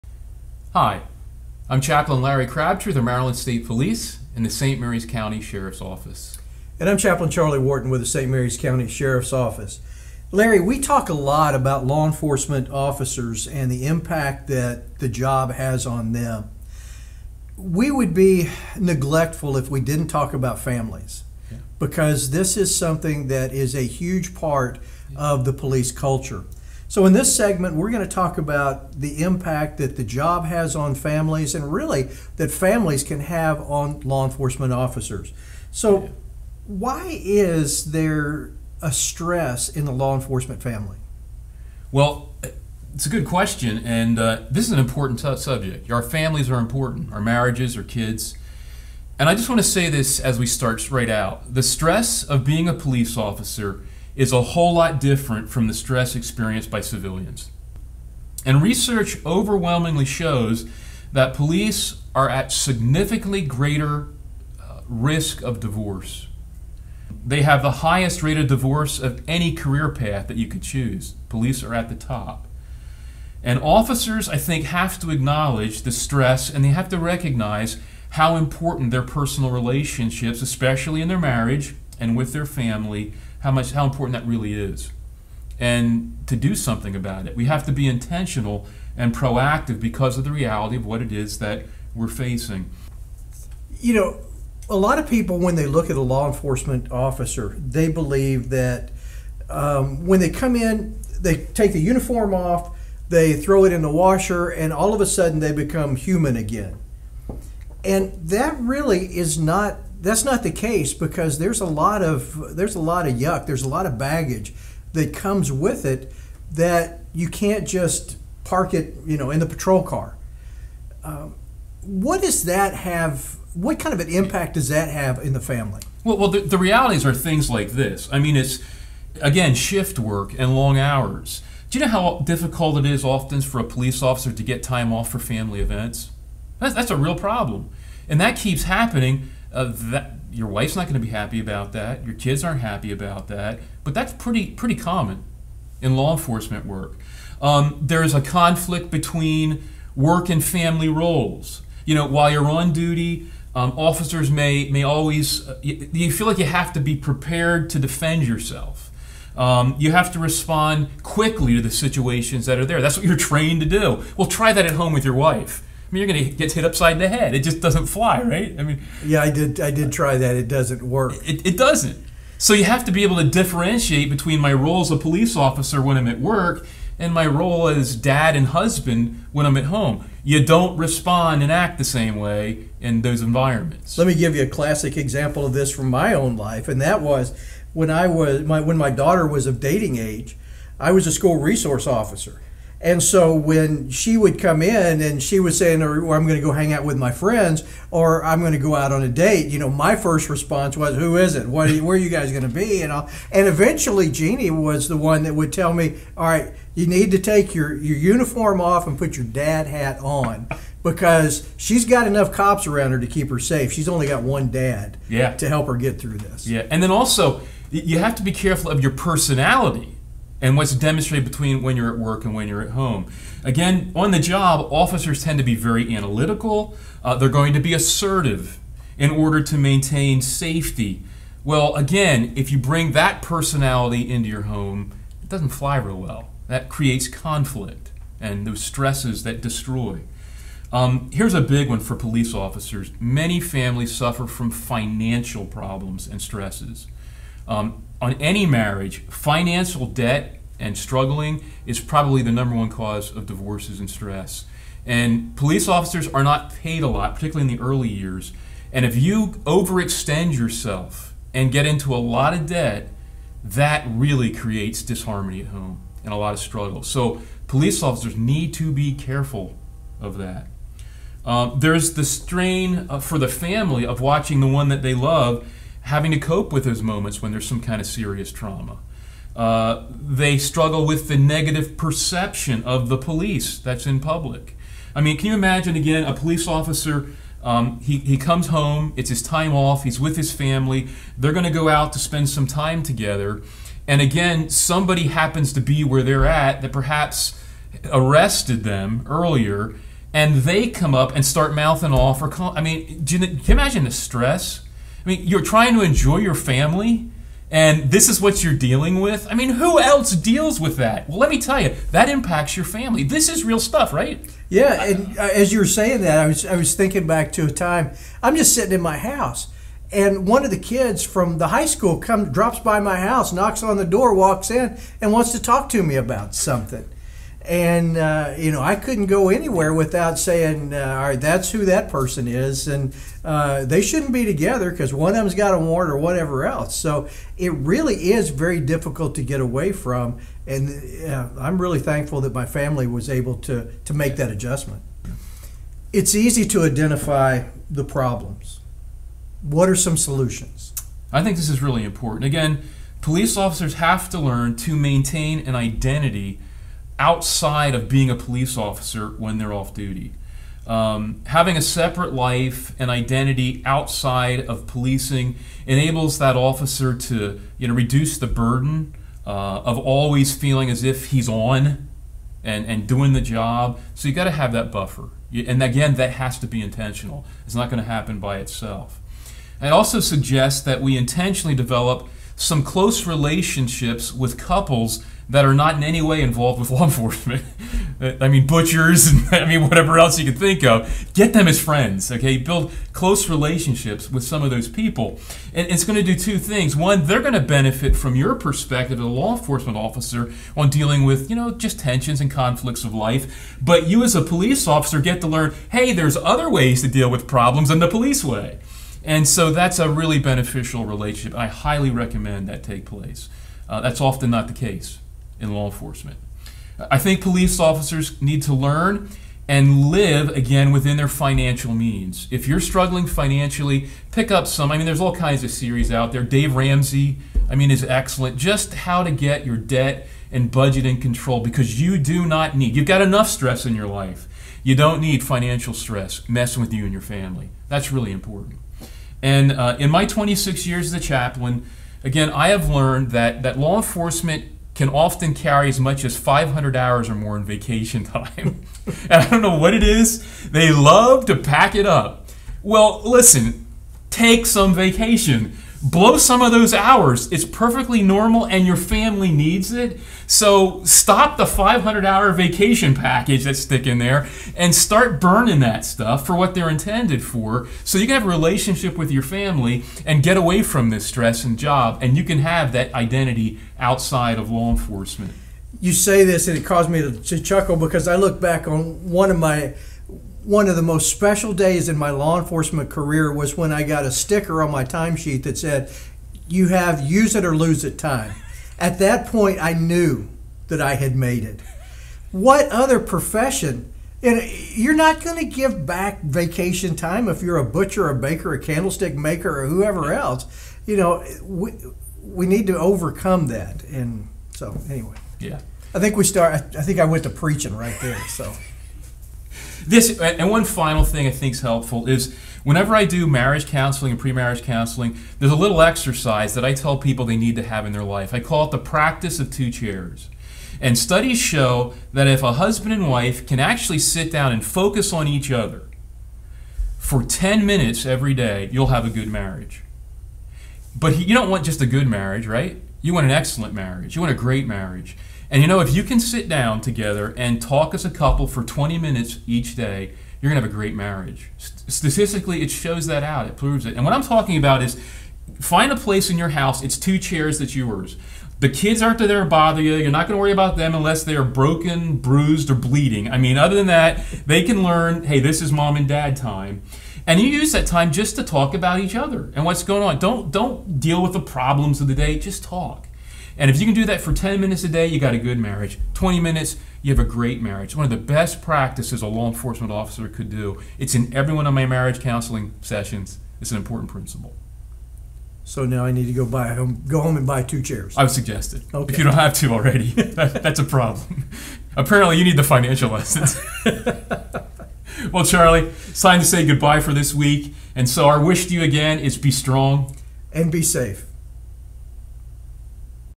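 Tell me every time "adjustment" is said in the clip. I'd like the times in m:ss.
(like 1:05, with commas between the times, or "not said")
5:44.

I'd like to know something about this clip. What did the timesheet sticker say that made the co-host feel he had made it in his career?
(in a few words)
Use it or lose it.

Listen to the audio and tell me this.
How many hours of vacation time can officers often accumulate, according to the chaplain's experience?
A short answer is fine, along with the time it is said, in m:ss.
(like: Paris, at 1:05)
500, at 7:26.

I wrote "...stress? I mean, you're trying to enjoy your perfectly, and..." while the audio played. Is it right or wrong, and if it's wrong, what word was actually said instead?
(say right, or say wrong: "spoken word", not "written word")
wrong: "family", not "perfectly".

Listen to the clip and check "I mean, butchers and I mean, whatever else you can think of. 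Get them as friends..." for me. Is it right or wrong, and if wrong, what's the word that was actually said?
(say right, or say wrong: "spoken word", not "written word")
right.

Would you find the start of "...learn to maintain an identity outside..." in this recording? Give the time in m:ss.
5:54.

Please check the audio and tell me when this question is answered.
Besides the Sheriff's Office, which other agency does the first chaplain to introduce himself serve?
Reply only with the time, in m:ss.
0:03.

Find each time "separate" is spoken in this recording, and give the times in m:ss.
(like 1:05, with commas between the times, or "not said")
6:01.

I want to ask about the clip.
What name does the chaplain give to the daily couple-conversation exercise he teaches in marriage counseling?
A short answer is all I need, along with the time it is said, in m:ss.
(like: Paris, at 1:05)
Practice of two chairs, at 8:38.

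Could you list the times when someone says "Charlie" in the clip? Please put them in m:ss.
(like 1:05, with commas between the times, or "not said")
0:07, 9:45.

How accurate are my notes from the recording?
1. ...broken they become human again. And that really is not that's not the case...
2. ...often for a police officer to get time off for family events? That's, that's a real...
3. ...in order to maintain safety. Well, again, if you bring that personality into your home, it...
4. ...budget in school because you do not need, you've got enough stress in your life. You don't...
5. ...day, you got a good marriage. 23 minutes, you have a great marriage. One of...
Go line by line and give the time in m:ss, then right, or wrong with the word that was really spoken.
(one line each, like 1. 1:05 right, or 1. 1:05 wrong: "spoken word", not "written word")
1. 1:45 wrong: "sudden", not "broken"
2. 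2:13 right
3. 3:48 right
4. 7:10 wrong: "control", not "school"
5. 9:24 wrong: "20", not "23".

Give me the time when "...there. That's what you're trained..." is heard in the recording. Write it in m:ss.
2:42.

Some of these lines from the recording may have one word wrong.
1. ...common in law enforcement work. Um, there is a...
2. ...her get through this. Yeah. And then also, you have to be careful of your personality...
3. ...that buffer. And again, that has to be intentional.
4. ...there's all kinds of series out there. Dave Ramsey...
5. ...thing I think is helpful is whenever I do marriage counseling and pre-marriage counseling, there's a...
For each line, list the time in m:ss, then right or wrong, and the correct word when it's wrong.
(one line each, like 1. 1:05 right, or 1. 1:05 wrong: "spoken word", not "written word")
1. 2:24 right
2. 3:35 right
3. 6:14 right
4. 7:04 right
5. 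8:31 right.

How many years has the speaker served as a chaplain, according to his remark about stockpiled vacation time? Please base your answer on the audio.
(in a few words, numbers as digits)
26.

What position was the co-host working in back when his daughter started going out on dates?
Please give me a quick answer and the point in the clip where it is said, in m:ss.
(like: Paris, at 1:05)
School resource officer, at 3:11.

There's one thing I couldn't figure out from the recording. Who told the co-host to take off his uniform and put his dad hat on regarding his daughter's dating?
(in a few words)
Jeannie.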